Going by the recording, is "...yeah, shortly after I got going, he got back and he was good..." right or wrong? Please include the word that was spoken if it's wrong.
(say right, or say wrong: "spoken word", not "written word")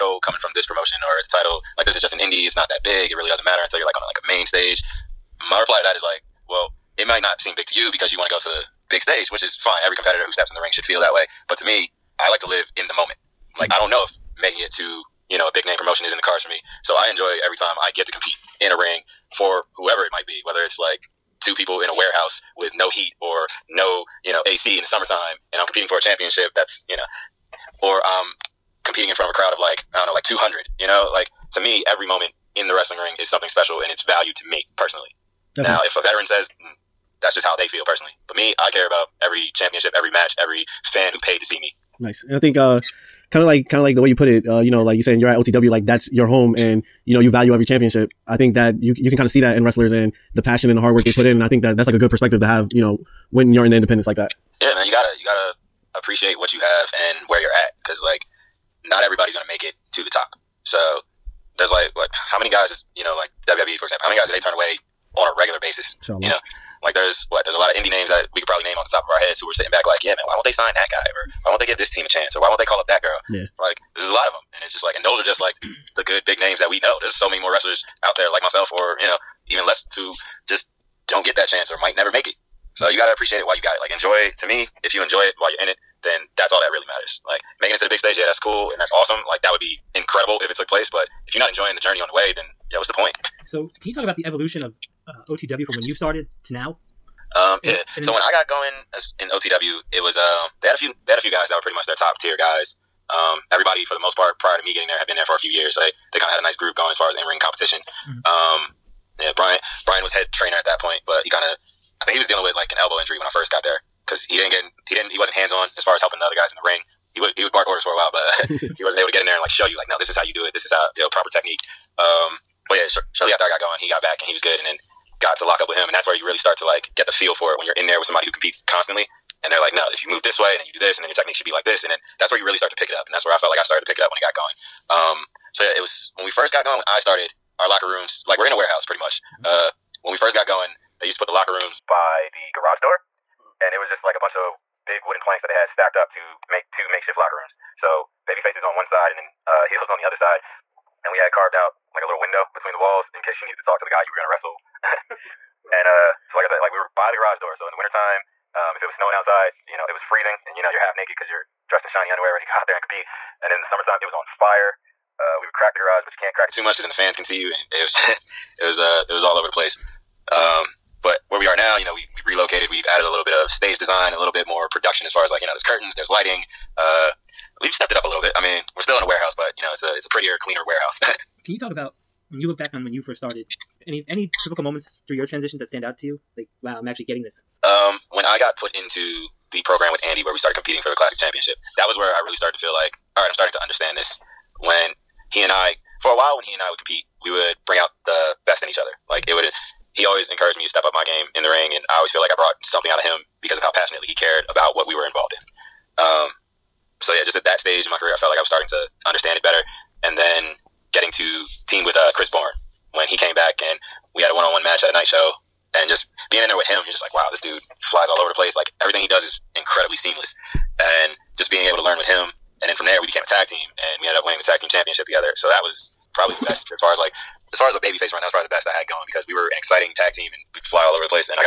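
right.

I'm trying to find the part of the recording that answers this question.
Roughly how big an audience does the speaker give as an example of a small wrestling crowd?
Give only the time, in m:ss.
0:30.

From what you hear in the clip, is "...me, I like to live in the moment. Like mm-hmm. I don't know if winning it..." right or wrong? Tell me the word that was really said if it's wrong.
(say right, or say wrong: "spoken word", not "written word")
wrong: "making", not "winning".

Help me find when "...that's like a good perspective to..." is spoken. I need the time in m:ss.
0:51.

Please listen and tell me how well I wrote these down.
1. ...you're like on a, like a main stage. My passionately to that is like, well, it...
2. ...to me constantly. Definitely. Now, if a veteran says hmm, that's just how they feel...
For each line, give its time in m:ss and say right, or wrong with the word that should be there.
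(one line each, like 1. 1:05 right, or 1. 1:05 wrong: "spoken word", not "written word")
1. 0:03 wrong: "reply", not "passionately"
2. 0:34 wrong: "personally", not "constantly".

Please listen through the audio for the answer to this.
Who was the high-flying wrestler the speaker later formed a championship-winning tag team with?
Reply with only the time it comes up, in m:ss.
3:32.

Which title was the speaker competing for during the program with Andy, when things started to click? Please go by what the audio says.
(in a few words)
Classic Championship.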